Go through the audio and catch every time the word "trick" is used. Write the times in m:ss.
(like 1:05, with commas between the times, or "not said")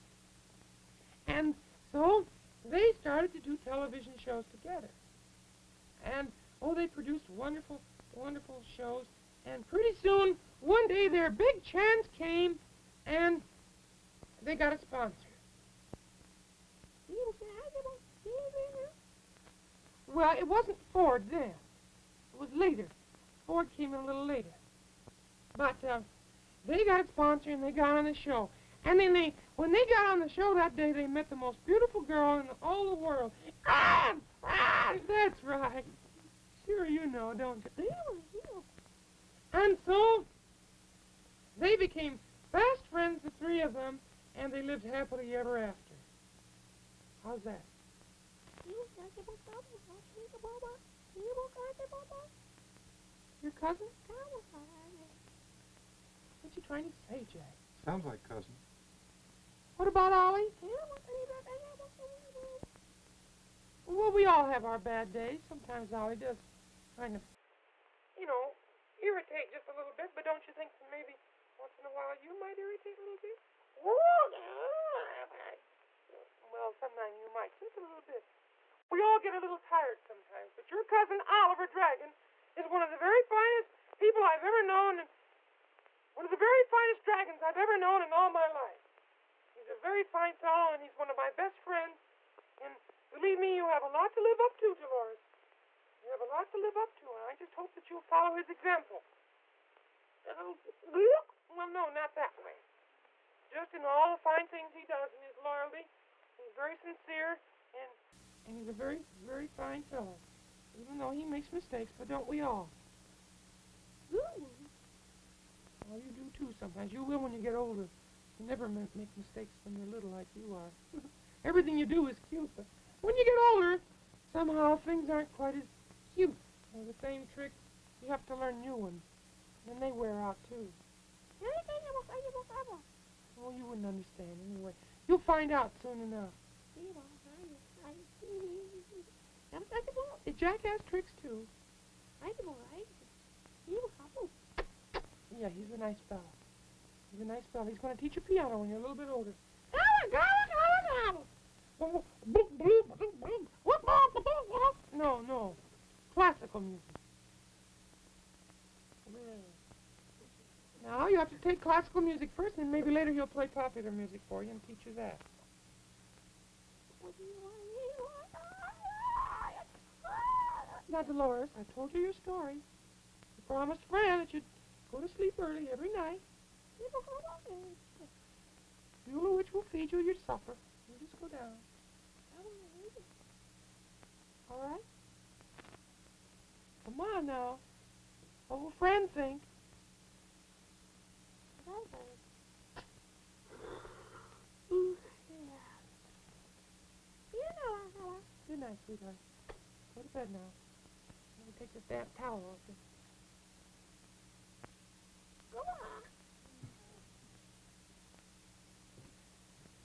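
2:07, 2:20.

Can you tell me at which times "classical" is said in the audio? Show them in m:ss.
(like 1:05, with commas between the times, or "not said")
2:36, 2:41.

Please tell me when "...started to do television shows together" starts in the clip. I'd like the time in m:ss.
0:03.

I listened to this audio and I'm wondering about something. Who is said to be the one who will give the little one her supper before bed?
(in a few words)
Beulah.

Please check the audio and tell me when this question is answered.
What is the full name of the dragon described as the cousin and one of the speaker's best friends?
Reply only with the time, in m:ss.
1:21.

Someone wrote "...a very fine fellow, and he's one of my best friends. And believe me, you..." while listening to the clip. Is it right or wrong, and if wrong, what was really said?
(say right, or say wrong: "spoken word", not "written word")
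right.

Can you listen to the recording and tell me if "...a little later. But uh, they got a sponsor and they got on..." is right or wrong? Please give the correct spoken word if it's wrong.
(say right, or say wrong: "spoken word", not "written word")
right.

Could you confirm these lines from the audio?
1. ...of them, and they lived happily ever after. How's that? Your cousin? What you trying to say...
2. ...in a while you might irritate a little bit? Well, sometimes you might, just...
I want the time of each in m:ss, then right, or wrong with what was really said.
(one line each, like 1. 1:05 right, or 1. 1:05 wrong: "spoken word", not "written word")
1. 0:43 right
2. 1:11 right.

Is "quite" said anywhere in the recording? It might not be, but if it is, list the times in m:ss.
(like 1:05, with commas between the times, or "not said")
2:05.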